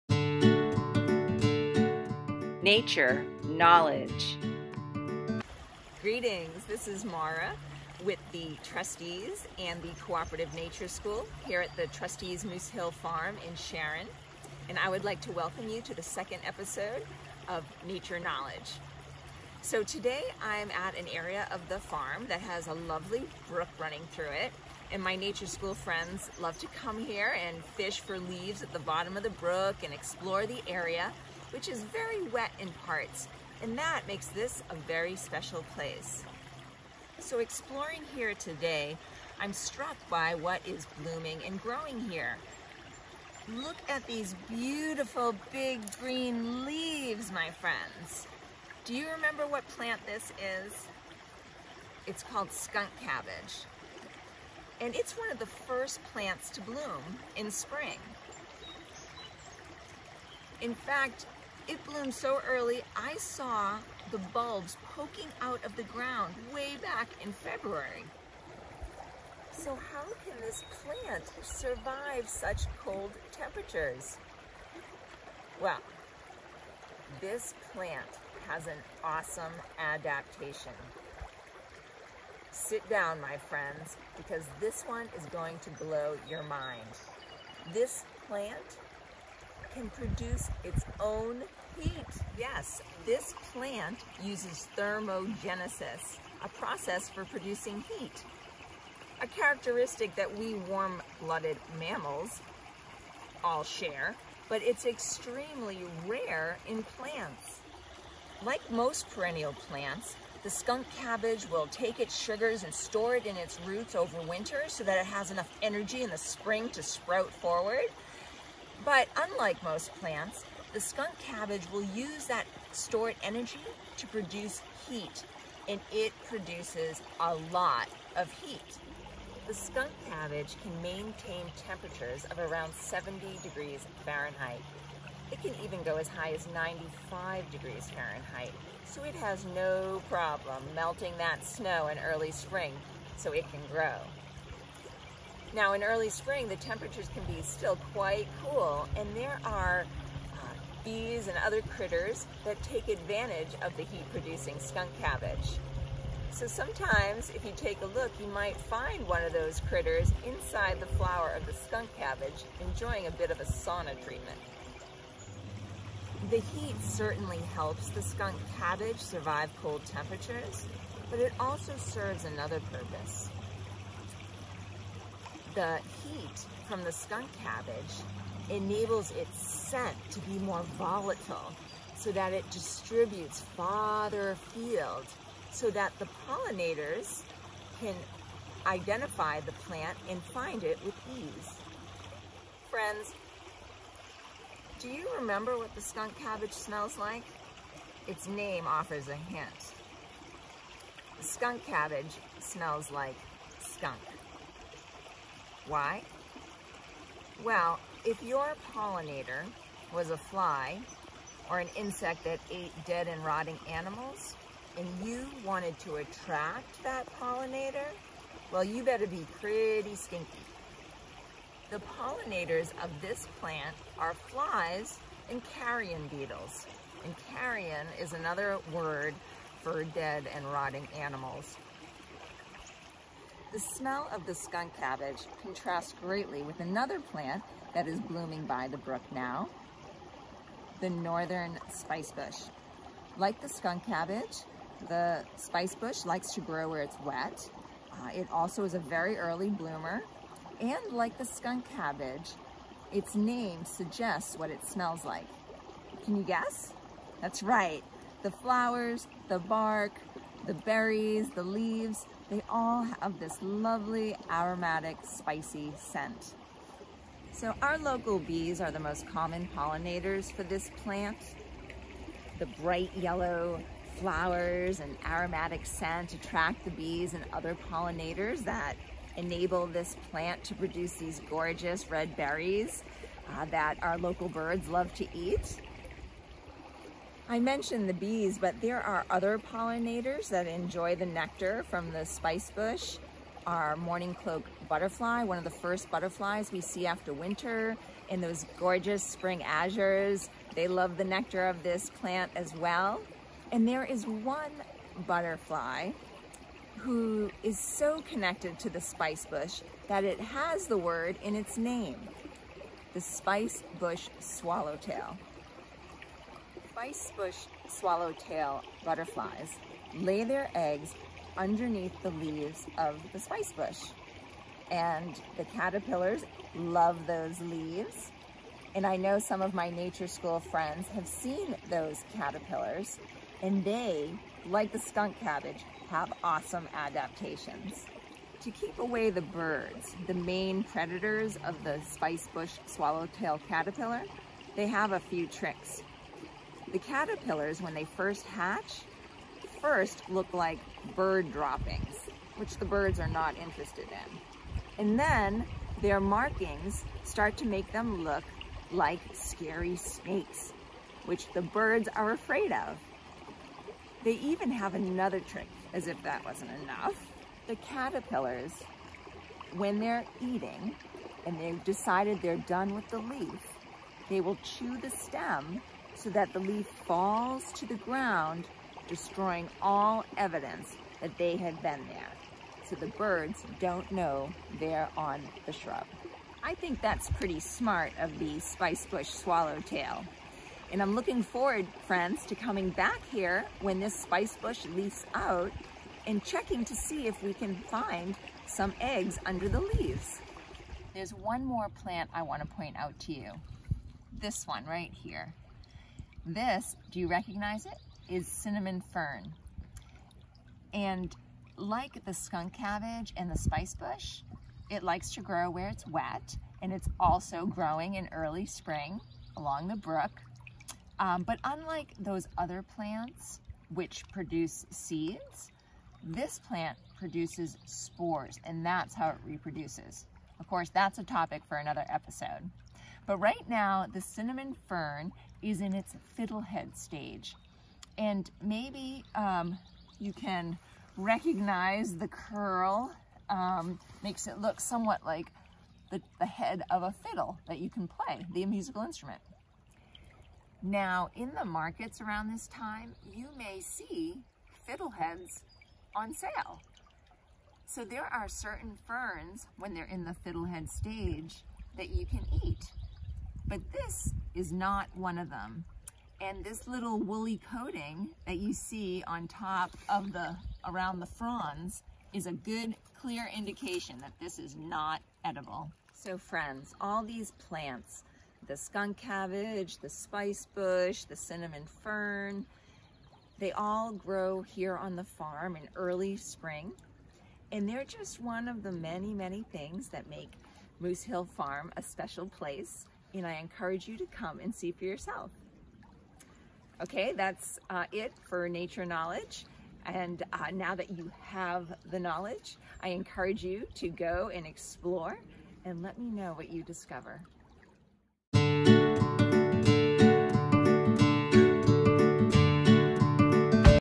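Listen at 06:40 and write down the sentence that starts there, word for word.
There's one more plant I want to point out to you.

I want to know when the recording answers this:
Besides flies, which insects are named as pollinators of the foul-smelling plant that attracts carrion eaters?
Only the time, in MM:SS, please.
03:45.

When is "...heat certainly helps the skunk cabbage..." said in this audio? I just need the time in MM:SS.
02:46.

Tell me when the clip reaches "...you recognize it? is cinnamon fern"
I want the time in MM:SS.
06:46.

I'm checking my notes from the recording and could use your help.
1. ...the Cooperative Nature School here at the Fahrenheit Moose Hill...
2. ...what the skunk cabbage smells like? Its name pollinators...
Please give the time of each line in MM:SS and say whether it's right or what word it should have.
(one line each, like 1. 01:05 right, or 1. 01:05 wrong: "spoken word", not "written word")
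1. 00:09 wrong: "Trustees", not "Fahrenheit"
2. 03:15 wrong: "offers", not "pollinators".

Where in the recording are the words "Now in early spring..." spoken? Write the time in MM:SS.
02:25.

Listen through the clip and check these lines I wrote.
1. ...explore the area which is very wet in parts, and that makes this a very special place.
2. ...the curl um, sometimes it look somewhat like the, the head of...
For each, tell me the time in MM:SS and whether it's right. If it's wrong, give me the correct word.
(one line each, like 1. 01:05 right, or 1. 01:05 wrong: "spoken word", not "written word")
1. 00:29 right
2. 07:21 wrong: "makes", not "sometimes".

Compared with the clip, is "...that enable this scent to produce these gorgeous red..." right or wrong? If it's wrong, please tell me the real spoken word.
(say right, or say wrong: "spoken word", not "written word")
wrong: "plant", not "scent".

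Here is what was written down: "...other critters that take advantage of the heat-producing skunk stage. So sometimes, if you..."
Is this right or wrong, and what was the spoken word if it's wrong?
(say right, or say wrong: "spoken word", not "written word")
wrong: "cabbage", not "stage".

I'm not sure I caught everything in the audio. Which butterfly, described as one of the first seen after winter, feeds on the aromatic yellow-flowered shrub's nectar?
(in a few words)
mourning cloak.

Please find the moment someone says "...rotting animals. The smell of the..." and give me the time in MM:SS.
03:50.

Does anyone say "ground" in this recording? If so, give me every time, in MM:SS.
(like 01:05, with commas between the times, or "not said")
01:05, 06:17.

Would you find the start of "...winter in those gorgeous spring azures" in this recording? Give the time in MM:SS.
04:57.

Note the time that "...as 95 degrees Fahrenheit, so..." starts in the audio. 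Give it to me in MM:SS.
02:16.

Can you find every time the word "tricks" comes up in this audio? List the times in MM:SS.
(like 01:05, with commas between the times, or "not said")
05:45, 06:05.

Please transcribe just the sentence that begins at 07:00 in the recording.
Um, but unlike those other plants, which produce seeds, this plant produces spores and that's how it reproduces.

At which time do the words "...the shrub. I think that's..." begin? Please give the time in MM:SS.
06:25.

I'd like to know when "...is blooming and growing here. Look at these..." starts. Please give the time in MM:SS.
00:40.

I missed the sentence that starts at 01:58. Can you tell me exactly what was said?
But unlike most plants, the skunk cabbage will use that stored energy to produce heat, and it produces a lot of heat.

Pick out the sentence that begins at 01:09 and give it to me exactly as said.
So how can this plant survive such cold temperatures?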